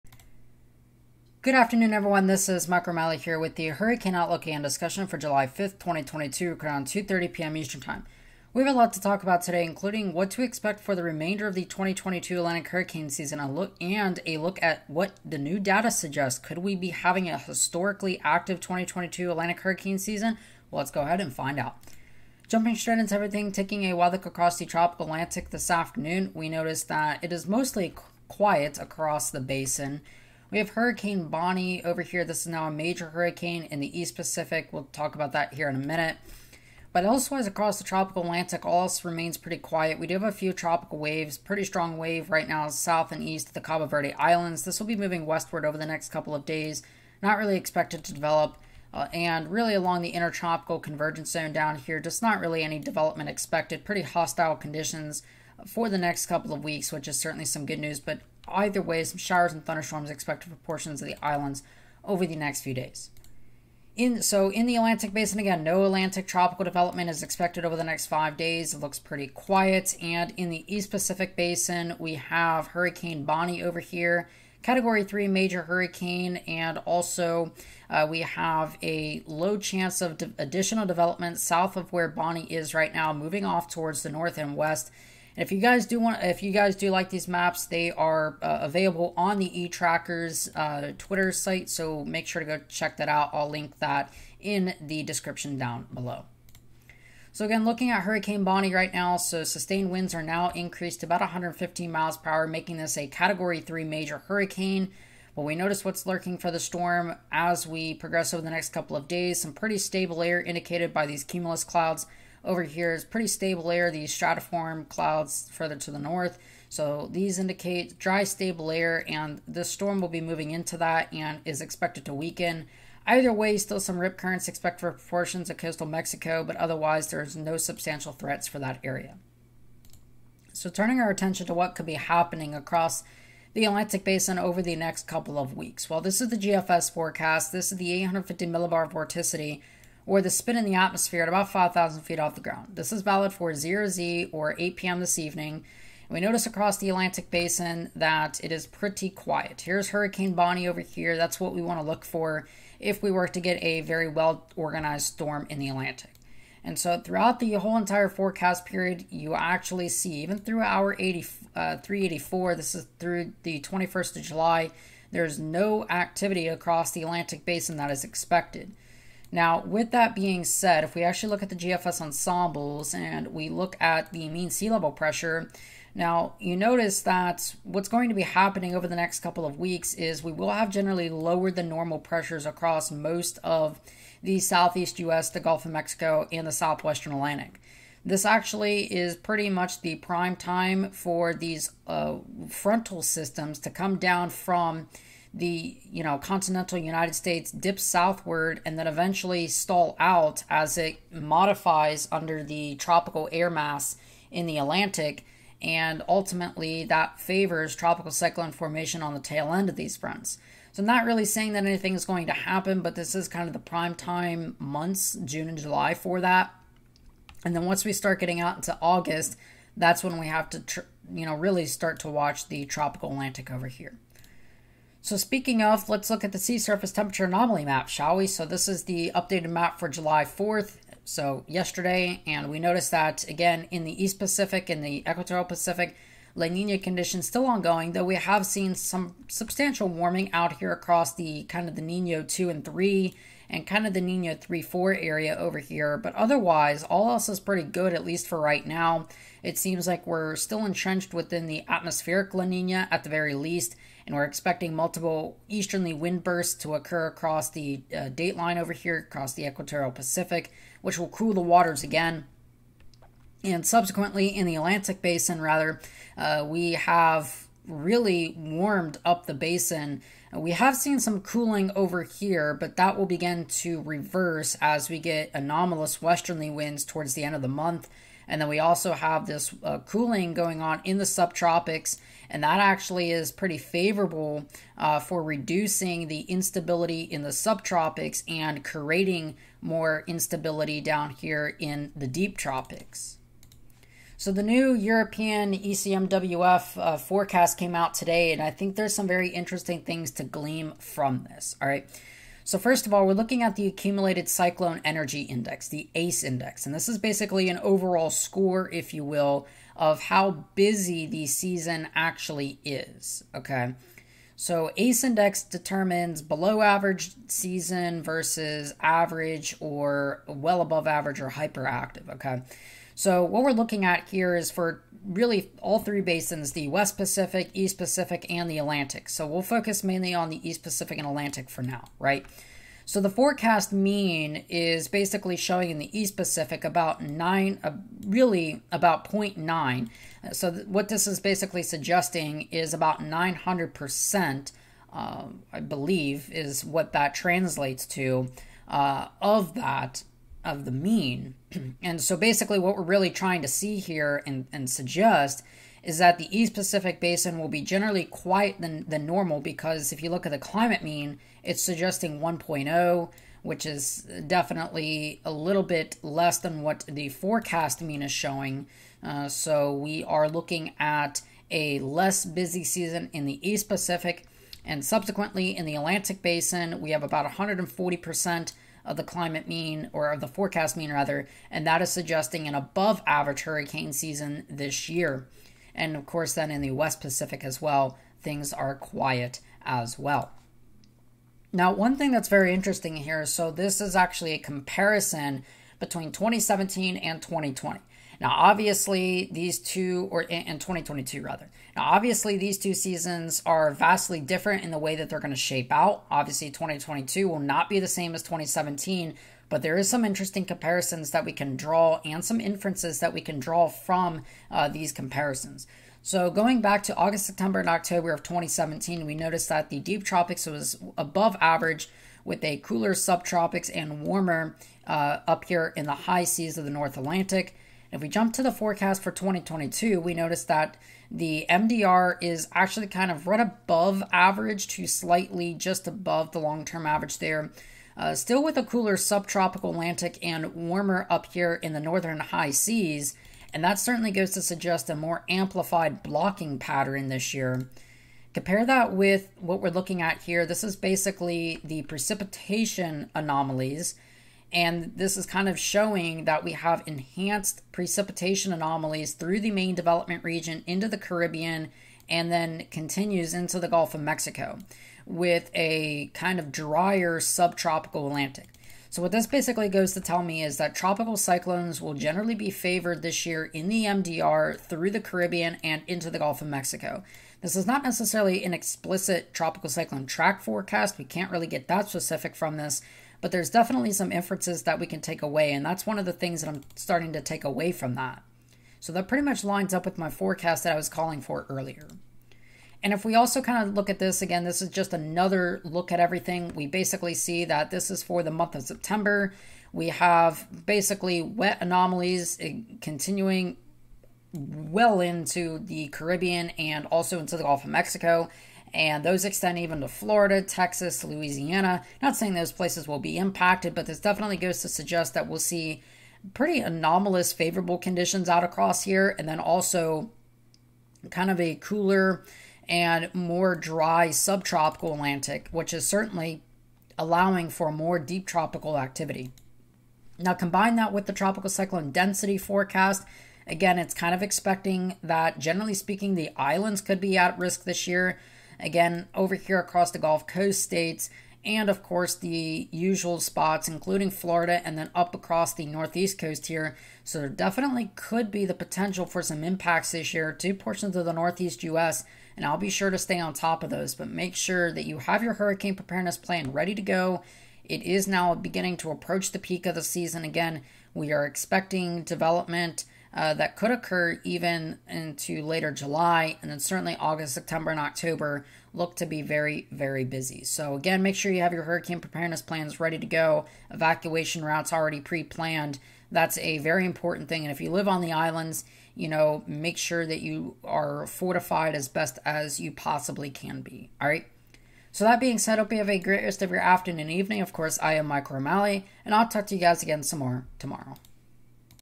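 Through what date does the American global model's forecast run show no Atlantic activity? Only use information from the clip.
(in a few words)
July 21.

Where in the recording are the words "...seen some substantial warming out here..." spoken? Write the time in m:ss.
3:58.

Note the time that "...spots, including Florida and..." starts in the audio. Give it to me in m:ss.
9:03.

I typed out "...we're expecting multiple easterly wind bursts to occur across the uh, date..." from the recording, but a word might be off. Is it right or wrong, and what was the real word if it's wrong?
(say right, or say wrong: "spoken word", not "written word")
right.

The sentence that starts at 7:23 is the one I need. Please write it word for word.
And that certainly goes to suggest a more amplified blocking pattern this year.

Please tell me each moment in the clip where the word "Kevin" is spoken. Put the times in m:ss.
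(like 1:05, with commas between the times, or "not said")
not said.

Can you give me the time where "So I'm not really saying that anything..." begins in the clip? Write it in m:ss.
3:30.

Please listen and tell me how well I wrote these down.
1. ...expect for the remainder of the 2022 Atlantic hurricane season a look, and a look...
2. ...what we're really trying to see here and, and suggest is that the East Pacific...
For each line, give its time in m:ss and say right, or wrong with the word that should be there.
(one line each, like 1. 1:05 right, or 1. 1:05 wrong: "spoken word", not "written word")
1. 0:10 right
2. 5:52 right.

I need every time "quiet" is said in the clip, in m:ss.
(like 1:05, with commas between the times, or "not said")
0:28, 0:39, 1:09, 2:29, 5:58, 6:28.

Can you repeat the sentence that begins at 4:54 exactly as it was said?
So the new European ECMWF uh, forecast came out today, and I think there's some very interesting things to glean from this.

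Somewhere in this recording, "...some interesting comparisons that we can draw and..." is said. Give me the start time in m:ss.
6:49.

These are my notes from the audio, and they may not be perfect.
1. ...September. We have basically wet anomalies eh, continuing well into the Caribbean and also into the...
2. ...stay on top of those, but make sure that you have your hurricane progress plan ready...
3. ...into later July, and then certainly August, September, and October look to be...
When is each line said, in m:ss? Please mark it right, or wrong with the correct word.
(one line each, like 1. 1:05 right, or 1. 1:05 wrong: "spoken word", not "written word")
1. 8:18 right
2. 9:12 wrong: "preparedness", not "progress"
3. 9:24 right.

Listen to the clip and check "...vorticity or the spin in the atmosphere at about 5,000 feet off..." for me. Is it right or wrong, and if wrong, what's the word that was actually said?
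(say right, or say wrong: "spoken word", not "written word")
right.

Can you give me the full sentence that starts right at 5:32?
So the forecast mean is basically showing in the East Pacific about 9, uh, really about 0.9.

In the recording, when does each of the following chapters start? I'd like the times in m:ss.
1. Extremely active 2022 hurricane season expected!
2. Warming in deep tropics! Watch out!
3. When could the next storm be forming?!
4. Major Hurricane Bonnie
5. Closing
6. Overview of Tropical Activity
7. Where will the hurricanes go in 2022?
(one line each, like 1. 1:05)
1. 4:53
2. 3:45
3. 2:10
4. 1:37
5. 9:31
6. 0:21
7. 7:27.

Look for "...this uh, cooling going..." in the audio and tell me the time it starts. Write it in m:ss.
4:39.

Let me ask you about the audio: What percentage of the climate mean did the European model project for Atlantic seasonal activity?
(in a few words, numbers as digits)
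140%.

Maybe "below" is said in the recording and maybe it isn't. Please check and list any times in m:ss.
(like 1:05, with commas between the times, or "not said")
1:35, 5:16.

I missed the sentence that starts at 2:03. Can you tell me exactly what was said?
Either way, still some rip currents expected for portions of coastal Mexico, but otherwise there's no substantial threats for that area.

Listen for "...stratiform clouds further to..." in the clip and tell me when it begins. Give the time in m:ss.
1:54.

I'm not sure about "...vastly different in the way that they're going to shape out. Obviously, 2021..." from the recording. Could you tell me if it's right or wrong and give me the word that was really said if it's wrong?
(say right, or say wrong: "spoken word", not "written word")
wrong: "2022", not "2021".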